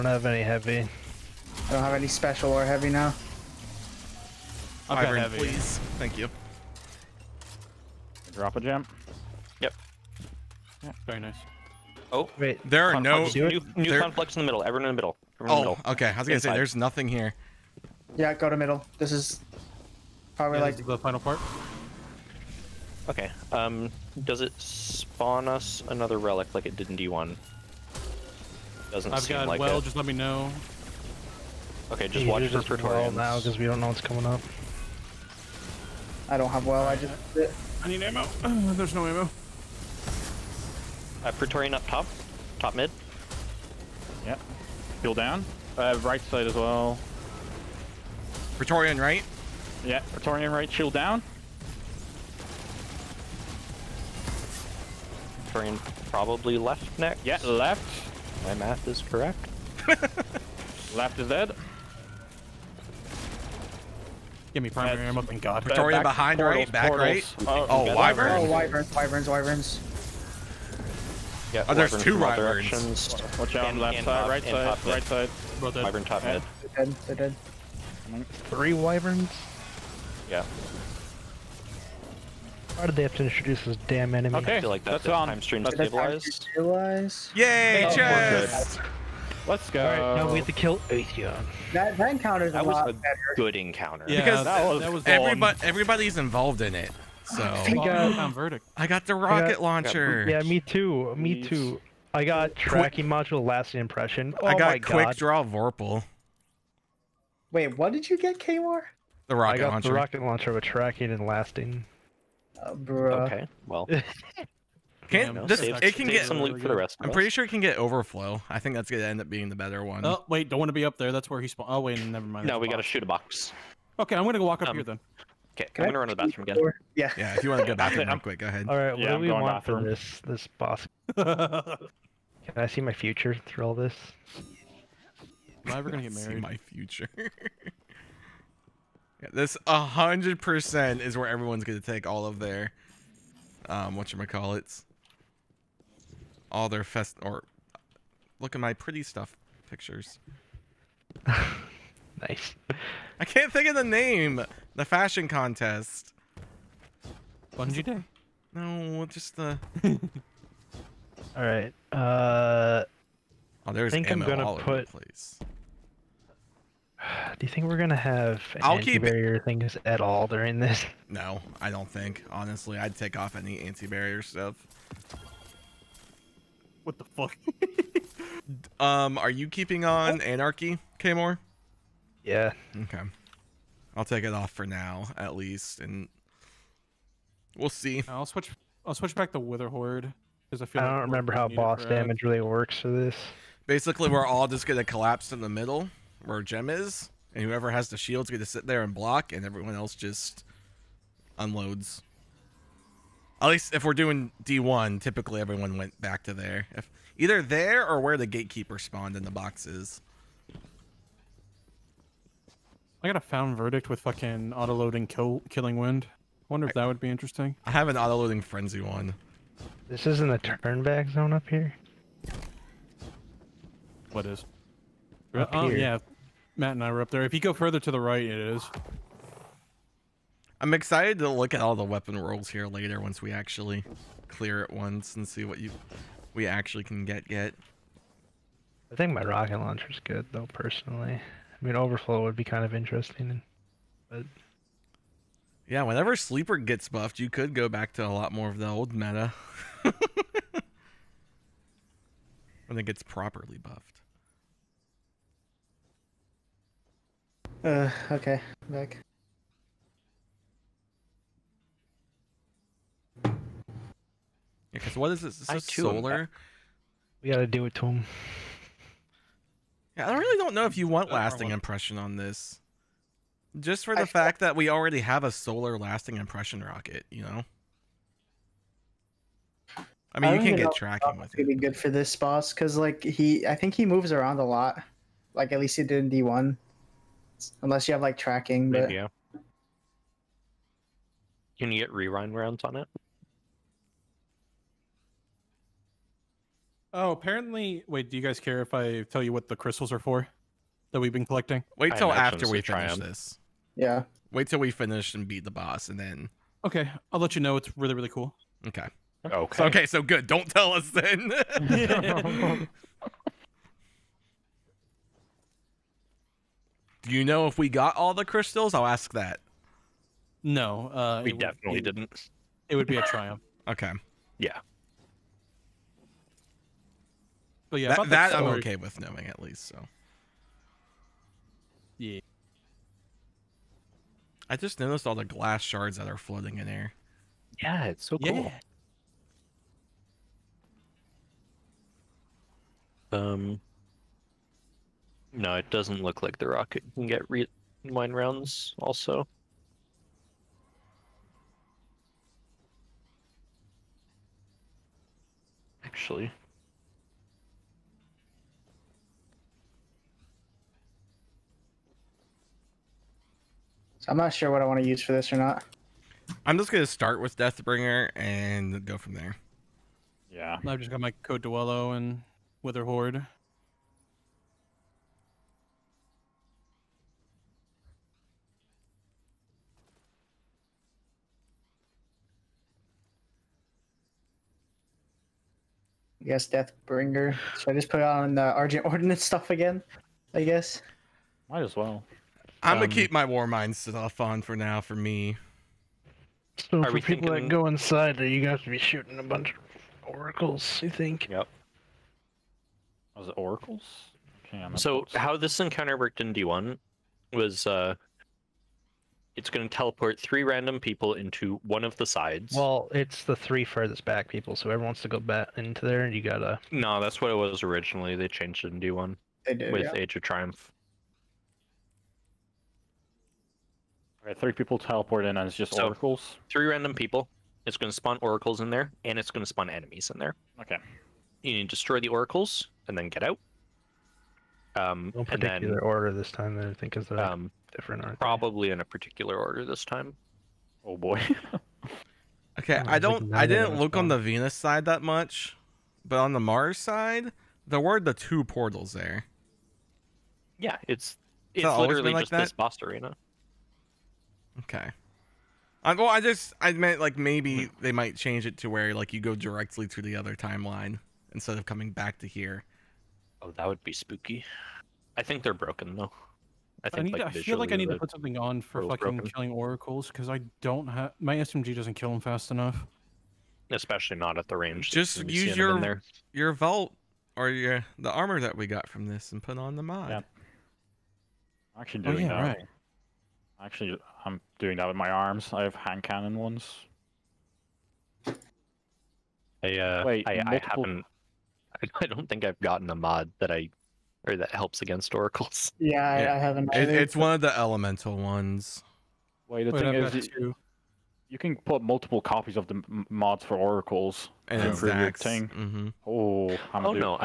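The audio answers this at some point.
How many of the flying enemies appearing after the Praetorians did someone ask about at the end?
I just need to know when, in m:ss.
1:18.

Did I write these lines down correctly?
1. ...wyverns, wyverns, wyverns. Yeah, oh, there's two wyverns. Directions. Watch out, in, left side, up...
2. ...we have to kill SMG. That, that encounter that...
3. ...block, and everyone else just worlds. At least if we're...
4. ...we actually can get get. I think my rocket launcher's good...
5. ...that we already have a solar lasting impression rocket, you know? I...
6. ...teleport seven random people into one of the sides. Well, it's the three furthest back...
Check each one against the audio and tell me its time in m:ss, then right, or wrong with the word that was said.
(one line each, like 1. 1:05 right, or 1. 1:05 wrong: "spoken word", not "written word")
1. 1:08 right
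2. 1:30 wrong: "Atheon", not "SMG"
3. 3:18 wrong: "unloads", not "worlds"
4. 3:56 right
5. 4:34 right
6. 6:49 wrong: "three", not "seven".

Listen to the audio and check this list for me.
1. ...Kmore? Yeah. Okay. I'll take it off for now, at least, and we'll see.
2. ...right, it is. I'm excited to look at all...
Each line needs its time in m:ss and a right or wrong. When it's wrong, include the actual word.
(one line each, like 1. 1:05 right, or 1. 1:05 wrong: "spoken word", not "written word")
1. 3:00 right
2. 3:48 right.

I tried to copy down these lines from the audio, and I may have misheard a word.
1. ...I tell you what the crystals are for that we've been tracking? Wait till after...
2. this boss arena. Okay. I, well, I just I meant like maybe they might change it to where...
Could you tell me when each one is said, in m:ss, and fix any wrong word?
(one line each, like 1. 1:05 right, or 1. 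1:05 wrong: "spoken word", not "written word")
1. 4:58 wrong: "collecting", not "tracking"
2. 7:32 right.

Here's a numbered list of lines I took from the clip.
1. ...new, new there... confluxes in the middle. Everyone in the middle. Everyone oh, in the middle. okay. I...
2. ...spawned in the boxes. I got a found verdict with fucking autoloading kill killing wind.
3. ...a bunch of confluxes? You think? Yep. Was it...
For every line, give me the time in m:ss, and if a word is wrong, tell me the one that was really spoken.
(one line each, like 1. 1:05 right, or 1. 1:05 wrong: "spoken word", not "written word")
1. 0:13 right
2. 3:28 right
3. 6:39 wrong: "oracles", not "confluxes".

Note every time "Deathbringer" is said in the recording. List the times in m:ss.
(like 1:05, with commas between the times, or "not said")
6:07, 6:26.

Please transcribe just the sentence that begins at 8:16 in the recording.
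It, it's one of the elemental ones.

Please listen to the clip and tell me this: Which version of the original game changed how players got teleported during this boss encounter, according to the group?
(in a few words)
Age of Triumph.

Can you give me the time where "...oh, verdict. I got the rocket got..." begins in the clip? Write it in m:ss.
1:38.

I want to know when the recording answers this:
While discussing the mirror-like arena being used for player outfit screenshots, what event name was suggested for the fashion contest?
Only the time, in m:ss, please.
2:37.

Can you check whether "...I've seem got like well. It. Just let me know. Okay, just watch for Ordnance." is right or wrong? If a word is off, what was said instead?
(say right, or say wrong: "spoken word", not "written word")
wrong: "Praetorians", not "Ordnance".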